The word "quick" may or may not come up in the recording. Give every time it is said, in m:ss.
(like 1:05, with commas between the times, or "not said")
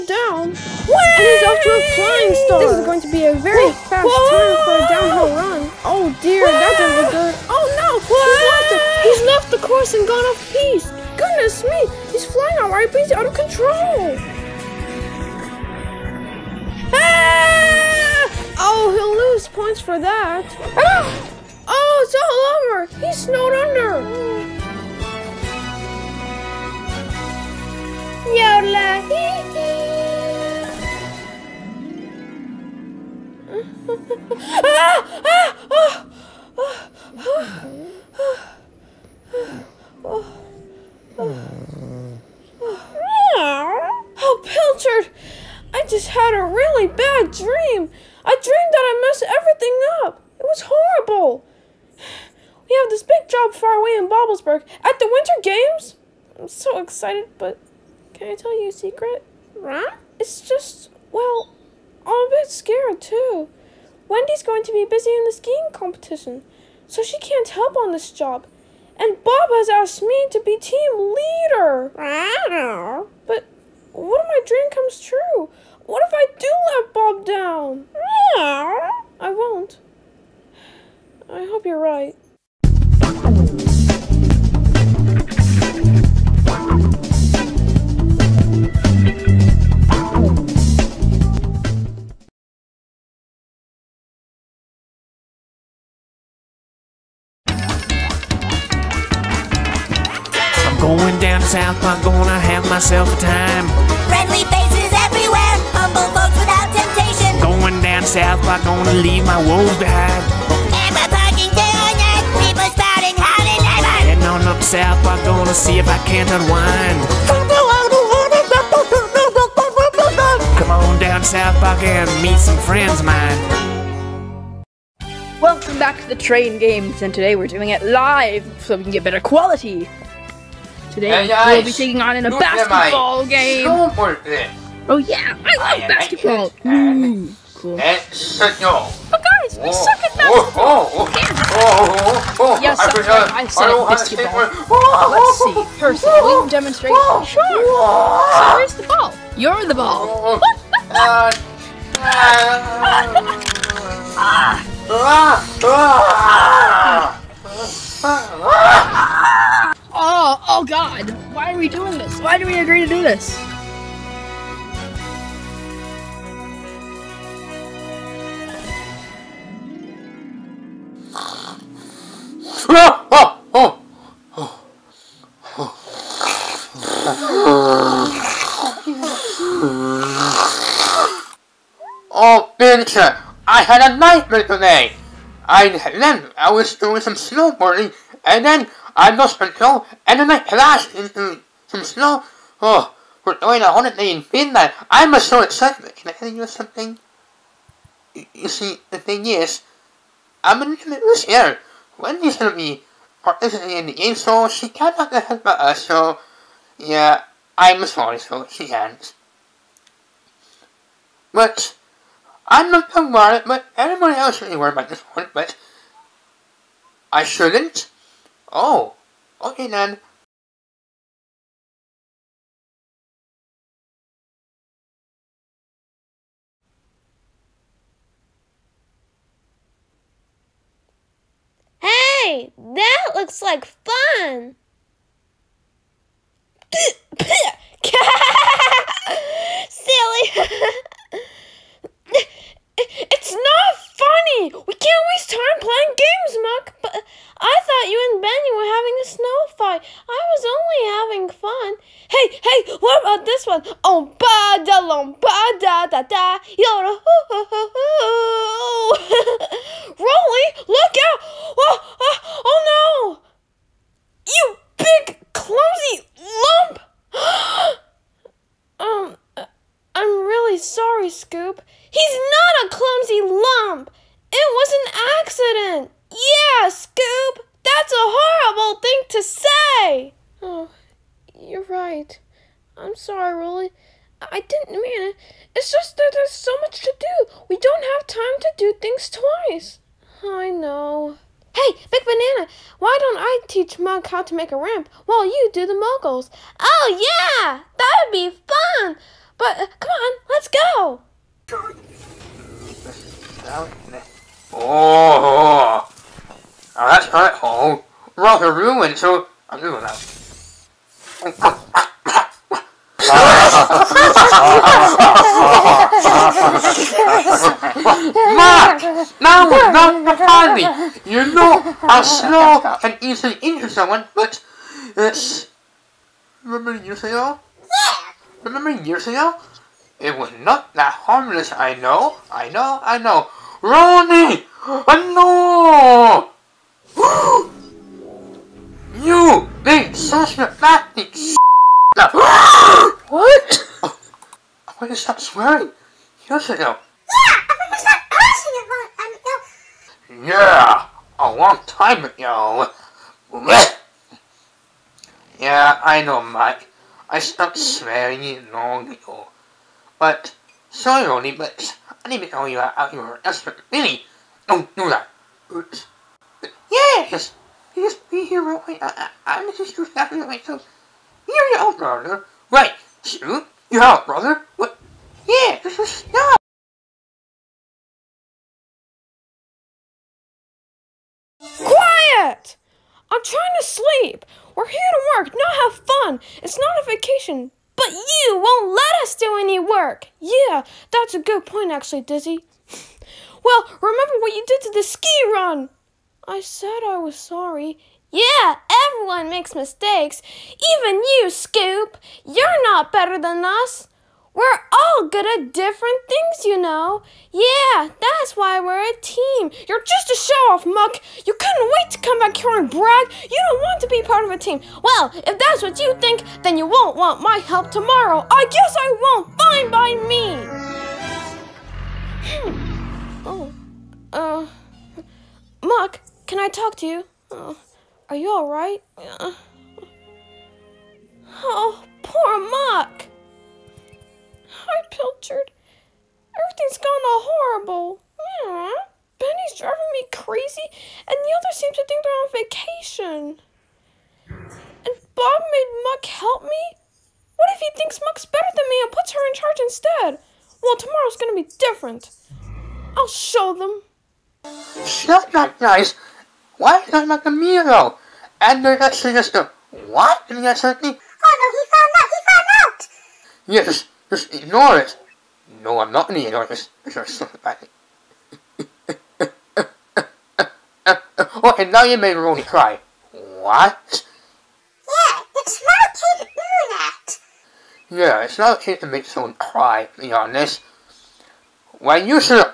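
6:08.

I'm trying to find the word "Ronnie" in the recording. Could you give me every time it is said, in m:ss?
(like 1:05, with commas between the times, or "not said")
5:33, 6:01.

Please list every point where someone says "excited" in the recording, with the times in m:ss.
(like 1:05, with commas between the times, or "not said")
0:56, 3:15.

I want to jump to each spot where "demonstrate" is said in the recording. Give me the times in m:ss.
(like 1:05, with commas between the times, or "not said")
2:26.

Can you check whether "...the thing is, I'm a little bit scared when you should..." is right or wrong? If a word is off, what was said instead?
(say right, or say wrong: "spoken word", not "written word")
right.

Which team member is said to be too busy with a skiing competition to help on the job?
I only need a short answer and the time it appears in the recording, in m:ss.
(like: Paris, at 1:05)
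Wendy, at 1:04.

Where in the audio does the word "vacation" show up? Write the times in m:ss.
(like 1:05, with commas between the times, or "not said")
6:26, 7:22.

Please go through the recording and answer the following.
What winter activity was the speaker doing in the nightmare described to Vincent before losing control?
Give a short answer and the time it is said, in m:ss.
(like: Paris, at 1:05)
Snowboarding, at 3:07.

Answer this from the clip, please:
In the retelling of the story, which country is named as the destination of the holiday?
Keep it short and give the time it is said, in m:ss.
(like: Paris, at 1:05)
Finland, at 3:14.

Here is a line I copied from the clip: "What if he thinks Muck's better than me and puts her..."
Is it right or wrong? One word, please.
right.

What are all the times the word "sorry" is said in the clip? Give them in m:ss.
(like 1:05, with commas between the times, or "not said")
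3:27, 6:00, 6:37.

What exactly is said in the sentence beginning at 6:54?
Well, if that's what you think, then you won't want my help tomorrow.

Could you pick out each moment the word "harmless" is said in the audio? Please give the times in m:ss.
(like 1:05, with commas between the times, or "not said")
5:30.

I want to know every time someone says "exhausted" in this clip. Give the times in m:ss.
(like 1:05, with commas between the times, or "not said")
not said.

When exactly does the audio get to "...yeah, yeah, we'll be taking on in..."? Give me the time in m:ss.
2:11.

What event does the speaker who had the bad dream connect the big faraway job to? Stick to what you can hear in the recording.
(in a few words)
The Winter Games.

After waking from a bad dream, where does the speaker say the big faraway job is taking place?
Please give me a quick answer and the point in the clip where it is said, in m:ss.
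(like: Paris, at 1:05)
Bobblesberg, at 0:54.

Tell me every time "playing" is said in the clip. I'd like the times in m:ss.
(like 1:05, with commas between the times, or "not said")
4:05.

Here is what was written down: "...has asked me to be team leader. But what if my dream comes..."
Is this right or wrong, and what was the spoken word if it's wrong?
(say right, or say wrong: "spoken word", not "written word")
right.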